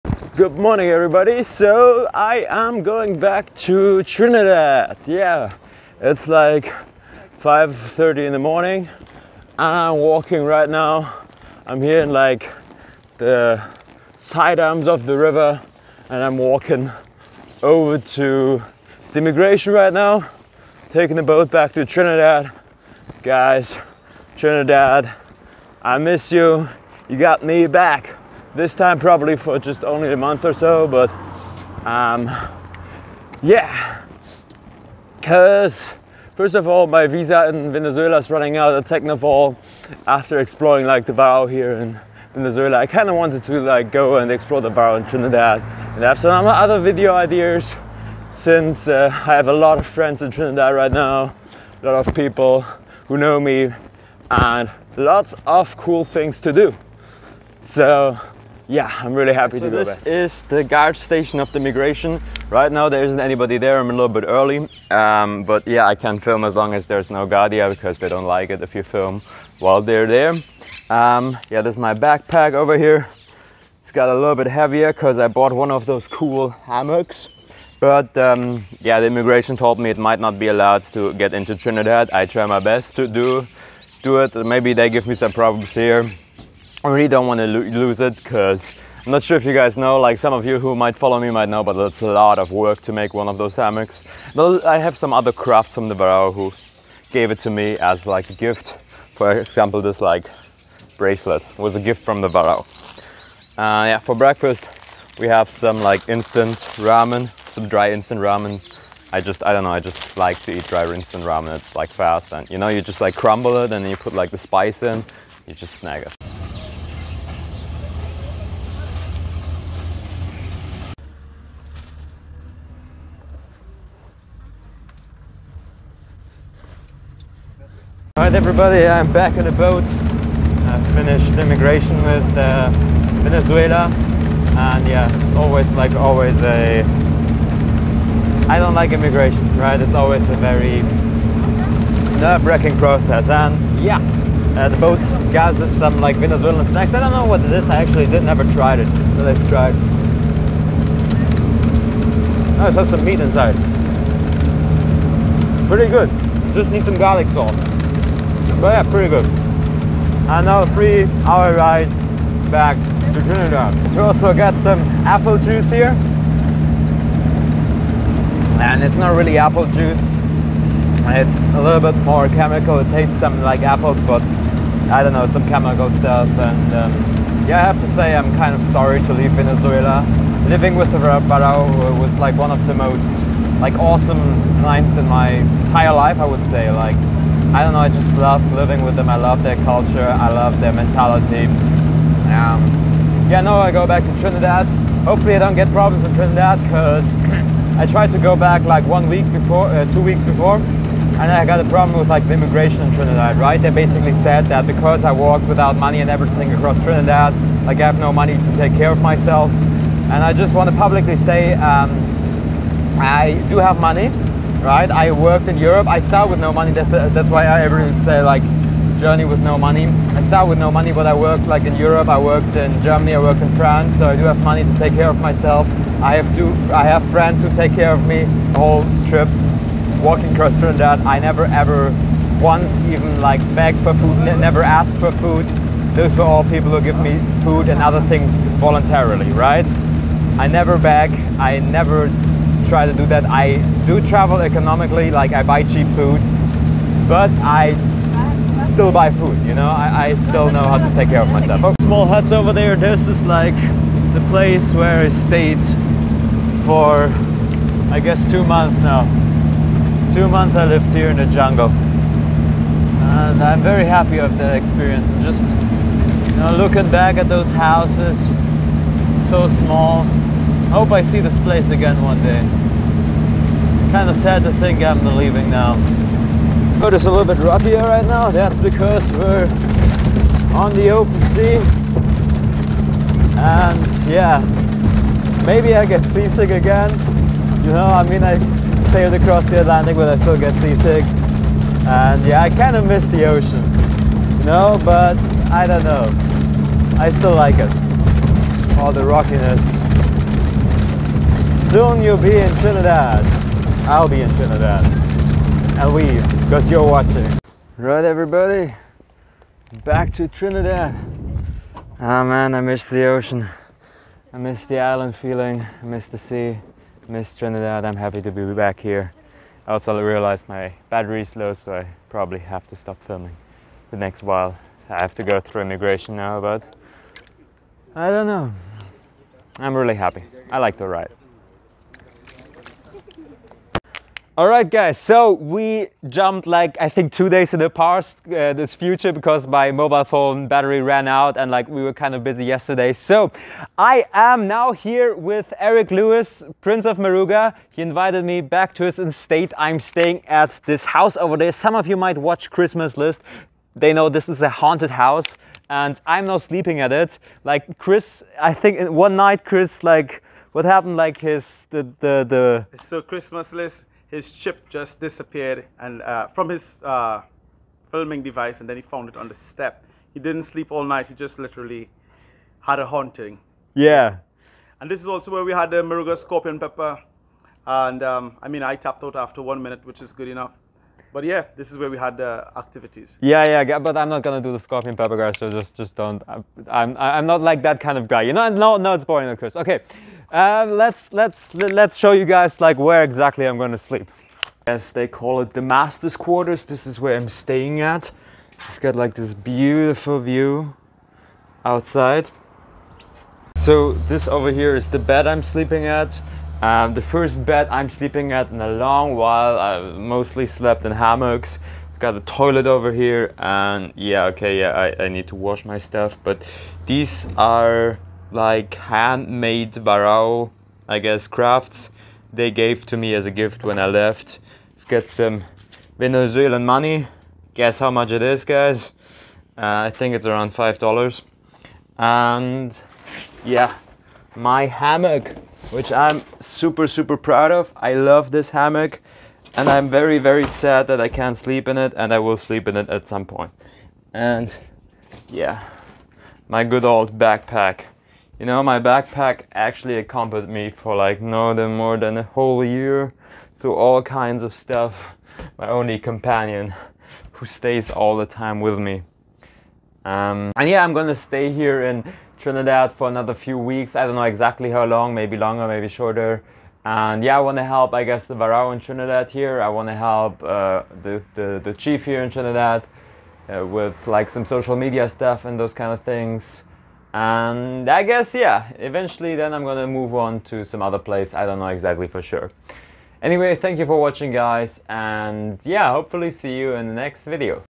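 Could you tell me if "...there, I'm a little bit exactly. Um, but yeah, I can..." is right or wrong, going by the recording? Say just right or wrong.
wrong.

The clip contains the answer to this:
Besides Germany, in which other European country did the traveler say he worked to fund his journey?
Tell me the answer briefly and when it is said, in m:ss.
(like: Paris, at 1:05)
France, at 3:43.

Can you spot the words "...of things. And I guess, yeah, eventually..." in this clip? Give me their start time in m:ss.
7:55.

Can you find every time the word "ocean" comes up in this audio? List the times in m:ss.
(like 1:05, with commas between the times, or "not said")
4:53, 5:13.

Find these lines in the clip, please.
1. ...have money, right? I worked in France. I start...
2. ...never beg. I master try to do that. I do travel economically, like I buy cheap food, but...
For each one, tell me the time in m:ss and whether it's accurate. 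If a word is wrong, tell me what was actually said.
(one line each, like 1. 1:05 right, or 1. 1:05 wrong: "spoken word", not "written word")
1. 3:33 wrong: "Europe", not "France"
2. 4:00 wrong: "never", not "master".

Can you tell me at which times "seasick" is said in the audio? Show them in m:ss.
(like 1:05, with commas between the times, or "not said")
4:46, 4:50.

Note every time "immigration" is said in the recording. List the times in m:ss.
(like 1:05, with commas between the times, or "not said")
0:19, 1:19, 2:11, 2:18, 3:22, 5:25.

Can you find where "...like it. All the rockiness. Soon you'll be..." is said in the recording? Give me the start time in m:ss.
4:57.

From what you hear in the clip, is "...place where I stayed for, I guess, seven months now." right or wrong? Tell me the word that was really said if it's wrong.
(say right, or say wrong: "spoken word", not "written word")
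wrong: "two", not "seven".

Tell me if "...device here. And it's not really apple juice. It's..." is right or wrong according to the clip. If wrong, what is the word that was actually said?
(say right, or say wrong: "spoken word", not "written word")
wrong: "juice", not "device".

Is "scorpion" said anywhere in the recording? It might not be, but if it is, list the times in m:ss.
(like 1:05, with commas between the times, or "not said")
6:16, 6:24.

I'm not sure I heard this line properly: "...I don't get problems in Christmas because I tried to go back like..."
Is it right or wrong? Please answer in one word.
wrong.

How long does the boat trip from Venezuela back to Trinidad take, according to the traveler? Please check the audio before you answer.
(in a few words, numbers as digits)
3 hours.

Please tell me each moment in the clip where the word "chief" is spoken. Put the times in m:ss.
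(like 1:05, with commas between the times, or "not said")
7:51.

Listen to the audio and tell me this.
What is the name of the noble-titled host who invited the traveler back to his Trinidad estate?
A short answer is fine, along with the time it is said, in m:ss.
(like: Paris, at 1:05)
Eric Lewis, at 5:45.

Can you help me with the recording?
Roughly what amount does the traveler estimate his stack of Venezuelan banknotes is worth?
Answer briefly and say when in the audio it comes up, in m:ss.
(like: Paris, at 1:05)
$5, at 7:10.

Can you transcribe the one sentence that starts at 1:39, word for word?
For example, this like bracelet was a gift from the Warao.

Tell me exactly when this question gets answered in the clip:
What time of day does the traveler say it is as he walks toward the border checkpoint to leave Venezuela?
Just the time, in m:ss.
0:07.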